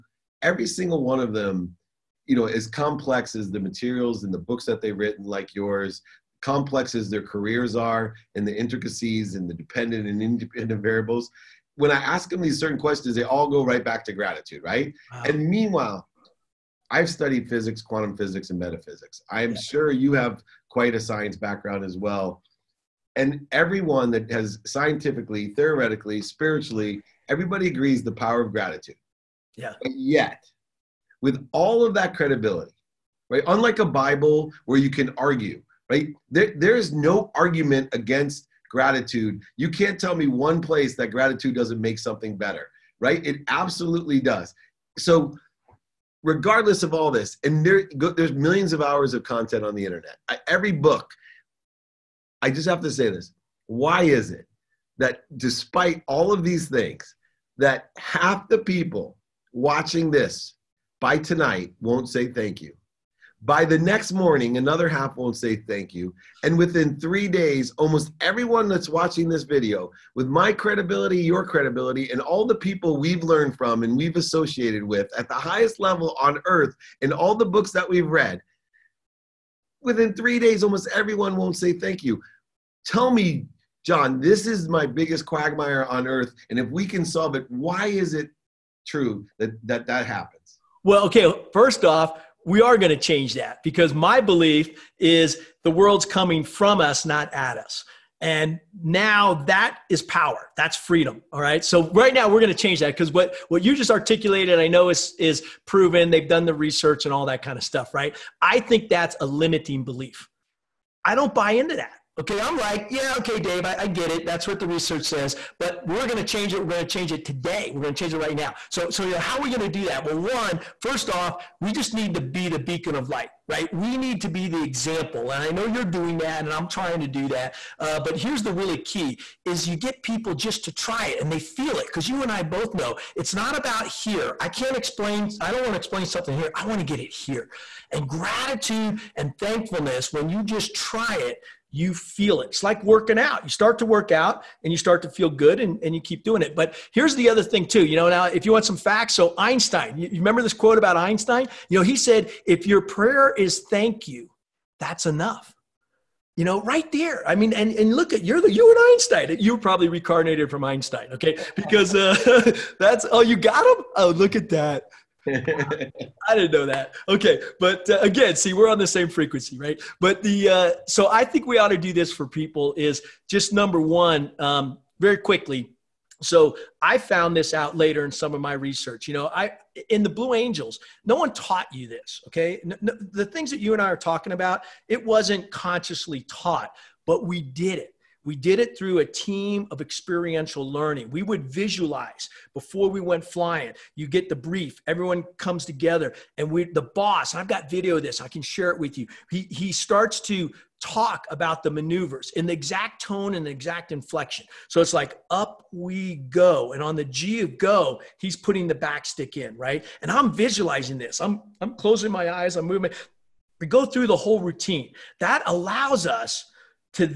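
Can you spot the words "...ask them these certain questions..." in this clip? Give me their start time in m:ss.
0:11.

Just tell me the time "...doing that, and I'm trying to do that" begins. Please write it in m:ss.
2:05.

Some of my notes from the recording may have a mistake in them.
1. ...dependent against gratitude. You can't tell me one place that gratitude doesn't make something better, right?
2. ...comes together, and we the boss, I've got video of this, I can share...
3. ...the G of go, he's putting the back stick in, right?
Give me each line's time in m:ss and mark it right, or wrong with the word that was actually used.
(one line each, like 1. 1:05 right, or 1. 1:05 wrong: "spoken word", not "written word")
1. 0:37 wrong: "argument", not "dependent"
2. 3:15 right
3. 3:26 right.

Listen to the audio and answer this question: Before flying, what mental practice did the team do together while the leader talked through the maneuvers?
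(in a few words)
Visualize.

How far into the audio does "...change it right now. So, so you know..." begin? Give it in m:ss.
1:57.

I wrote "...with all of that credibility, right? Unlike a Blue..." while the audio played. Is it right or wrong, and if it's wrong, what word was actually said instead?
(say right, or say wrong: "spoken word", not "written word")
wrong: "Bible", not "Blue".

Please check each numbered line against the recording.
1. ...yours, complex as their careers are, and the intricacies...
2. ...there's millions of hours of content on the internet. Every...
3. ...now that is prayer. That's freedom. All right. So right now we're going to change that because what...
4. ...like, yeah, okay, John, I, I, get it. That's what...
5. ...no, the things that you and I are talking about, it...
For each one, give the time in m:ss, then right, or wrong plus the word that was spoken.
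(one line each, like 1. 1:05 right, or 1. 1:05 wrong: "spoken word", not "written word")
1. 0:05 right
2. 0:47 right
3. 1:38 wrong: "power", not "prayer"
4. 1:52 wrong: "Dave", not "John"
5. 3:02 right.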